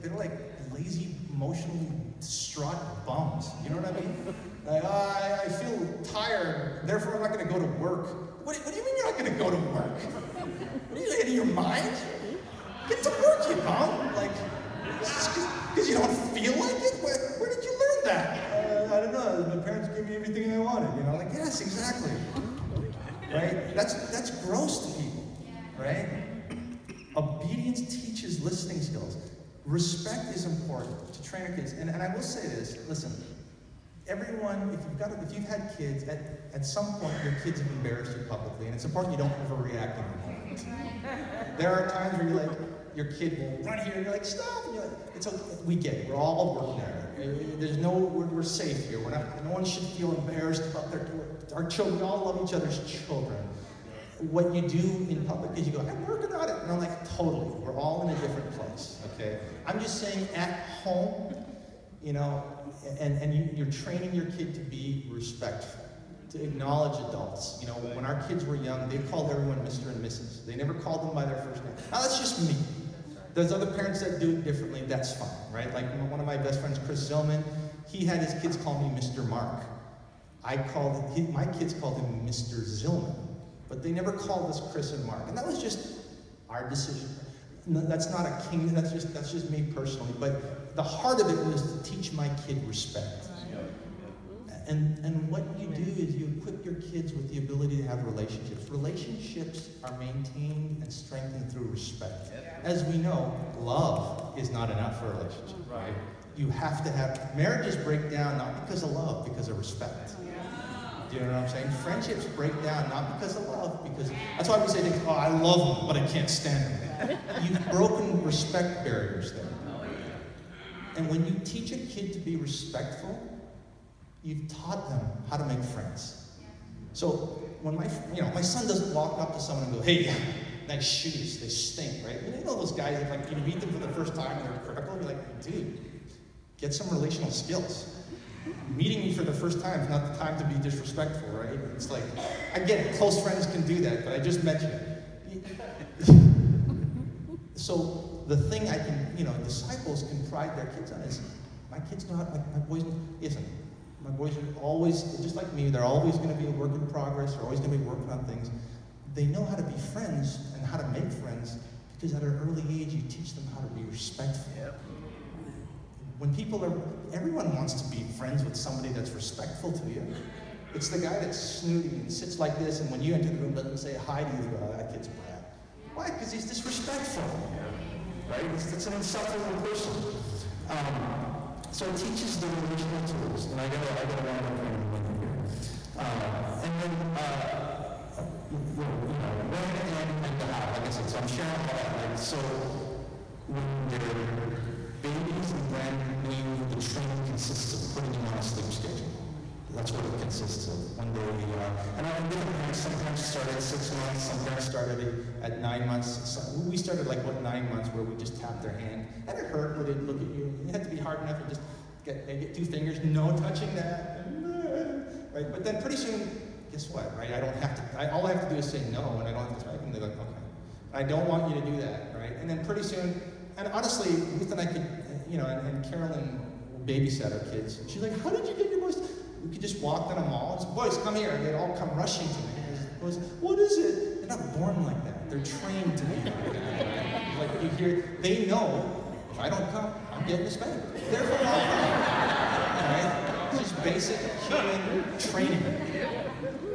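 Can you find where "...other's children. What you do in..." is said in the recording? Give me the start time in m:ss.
0:52.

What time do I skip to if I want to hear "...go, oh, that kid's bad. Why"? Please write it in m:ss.
2:54.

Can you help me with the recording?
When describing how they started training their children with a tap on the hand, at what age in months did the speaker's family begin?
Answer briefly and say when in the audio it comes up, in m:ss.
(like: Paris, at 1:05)
9, at 3:27.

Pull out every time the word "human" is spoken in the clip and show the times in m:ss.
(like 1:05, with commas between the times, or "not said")
4:04.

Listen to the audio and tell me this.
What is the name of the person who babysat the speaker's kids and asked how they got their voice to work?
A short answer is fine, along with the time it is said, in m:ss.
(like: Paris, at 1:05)
Carolyn, at 3:45.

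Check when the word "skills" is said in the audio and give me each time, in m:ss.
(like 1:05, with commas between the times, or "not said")
0:28, 2:17.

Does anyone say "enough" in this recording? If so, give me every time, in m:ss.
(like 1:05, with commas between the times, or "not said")
1:44, 3:31.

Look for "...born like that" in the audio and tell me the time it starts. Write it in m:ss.
3:54.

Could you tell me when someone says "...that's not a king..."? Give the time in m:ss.
1:27.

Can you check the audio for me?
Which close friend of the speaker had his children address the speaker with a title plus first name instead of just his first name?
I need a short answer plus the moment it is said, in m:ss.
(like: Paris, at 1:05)
Chris Zillman, at 1:16.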